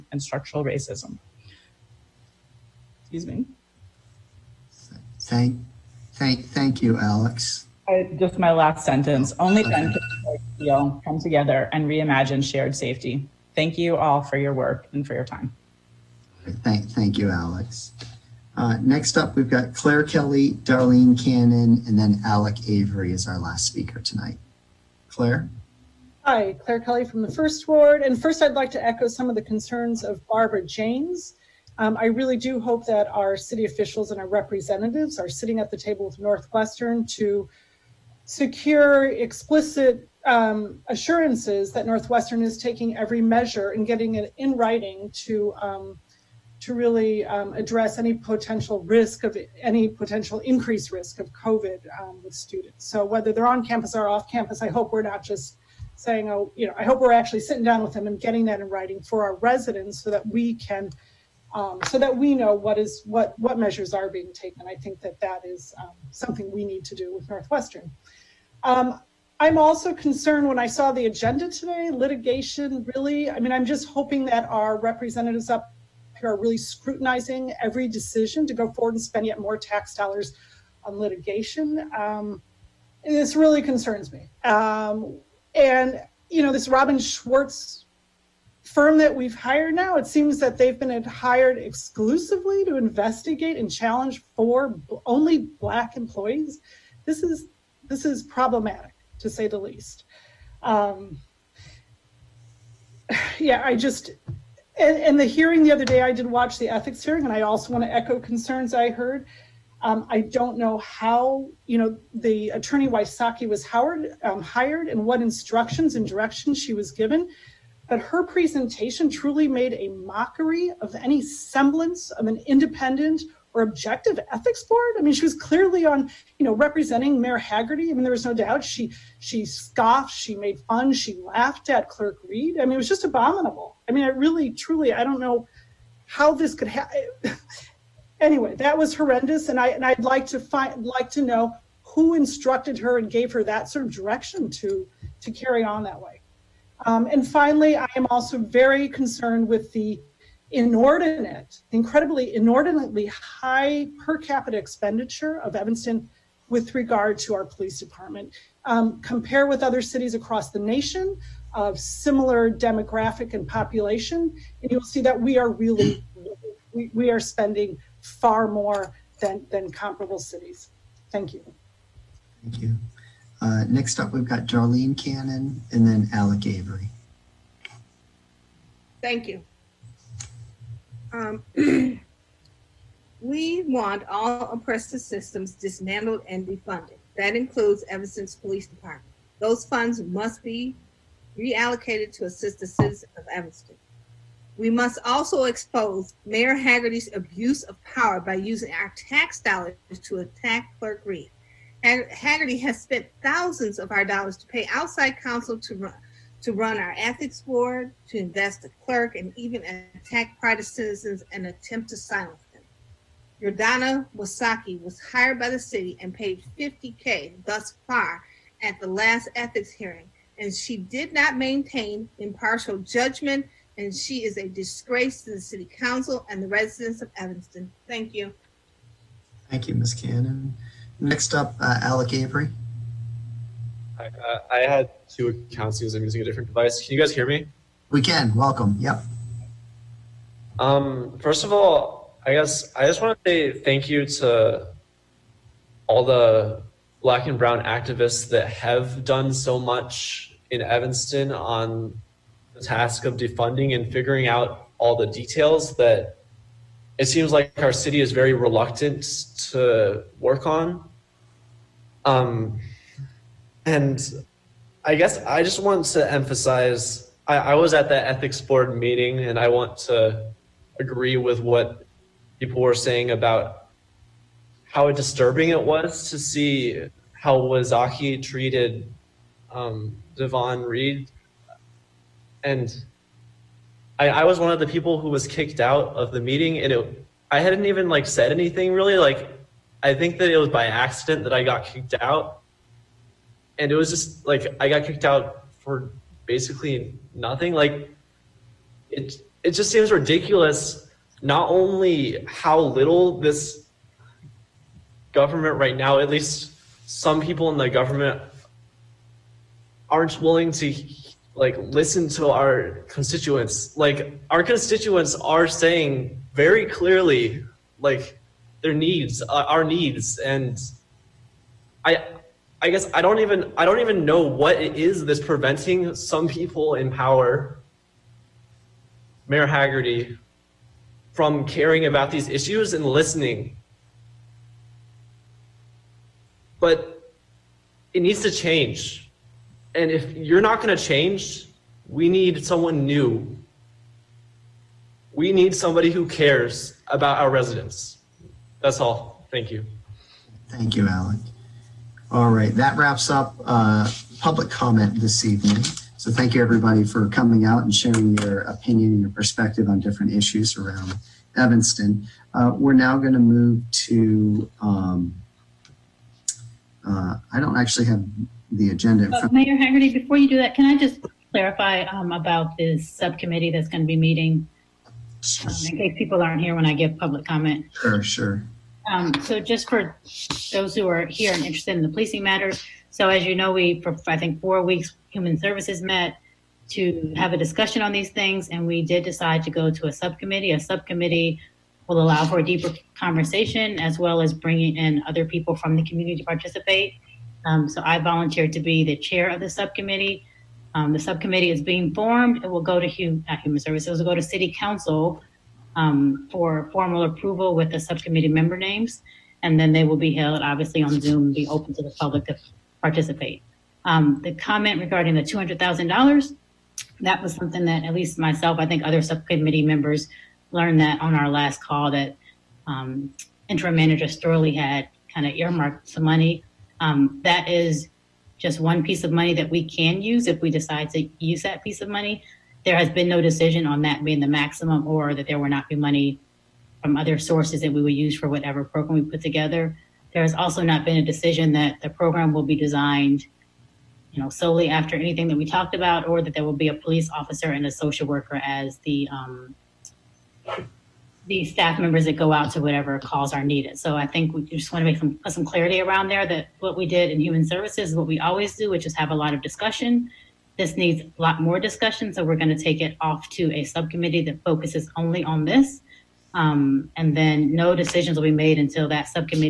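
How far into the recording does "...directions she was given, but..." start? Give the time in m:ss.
1:56.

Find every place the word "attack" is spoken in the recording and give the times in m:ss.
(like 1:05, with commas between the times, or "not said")
3:20, 3:29.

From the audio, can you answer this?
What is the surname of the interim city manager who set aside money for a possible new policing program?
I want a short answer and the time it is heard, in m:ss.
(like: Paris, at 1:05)
Storlie, at 7:04.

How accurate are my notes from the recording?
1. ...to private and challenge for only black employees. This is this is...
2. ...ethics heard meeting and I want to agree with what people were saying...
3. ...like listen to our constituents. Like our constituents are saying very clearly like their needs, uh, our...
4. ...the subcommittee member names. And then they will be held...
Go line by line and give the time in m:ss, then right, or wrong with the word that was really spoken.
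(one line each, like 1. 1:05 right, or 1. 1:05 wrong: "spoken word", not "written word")
1. 1:32 wrong: "investigate", not "private"
2. 4:28 wrong: "board", not "heard"
3. 5:11 right
4. 6:47 right.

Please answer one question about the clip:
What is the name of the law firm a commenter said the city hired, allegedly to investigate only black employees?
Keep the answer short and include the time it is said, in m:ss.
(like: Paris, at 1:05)
Robbins Schwartz, at 1:26.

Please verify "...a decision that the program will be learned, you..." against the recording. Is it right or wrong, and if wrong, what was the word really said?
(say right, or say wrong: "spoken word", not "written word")
wrong: "designed", not "learned".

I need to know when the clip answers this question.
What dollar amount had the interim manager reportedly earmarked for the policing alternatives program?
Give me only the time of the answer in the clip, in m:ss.
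6:55.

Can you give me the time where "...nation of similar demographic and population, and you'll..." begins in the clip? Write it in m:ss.
2:40.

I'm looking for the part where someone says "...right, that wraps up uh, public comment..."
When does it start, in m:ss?
5:52.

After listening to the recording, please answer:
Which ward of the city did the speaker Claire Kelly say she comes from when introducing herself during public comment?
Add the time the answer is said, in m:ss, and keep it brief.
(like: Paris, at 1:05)
First Ward, at 0:27.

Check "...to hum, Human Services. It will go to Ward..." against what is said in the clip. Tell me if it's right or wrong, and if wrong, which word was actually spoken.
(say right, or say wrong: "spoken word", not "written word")
wrong: "City", not "Ward".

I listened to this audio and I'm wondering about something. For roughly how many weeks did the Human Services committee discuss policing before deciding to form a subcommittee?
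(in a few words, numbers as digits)
4 weeks.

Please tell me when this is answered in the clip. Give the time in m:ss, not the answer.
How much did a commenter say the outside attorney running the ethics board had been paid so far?
3:36.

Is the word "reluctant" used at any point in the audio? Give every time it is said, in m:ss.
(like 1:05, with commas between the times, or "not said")
4:18.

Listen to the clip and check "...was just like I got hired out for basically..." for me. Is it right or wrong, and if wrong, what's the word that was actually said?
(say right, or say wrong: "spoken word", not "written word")
wrong: "kicked", not "hired".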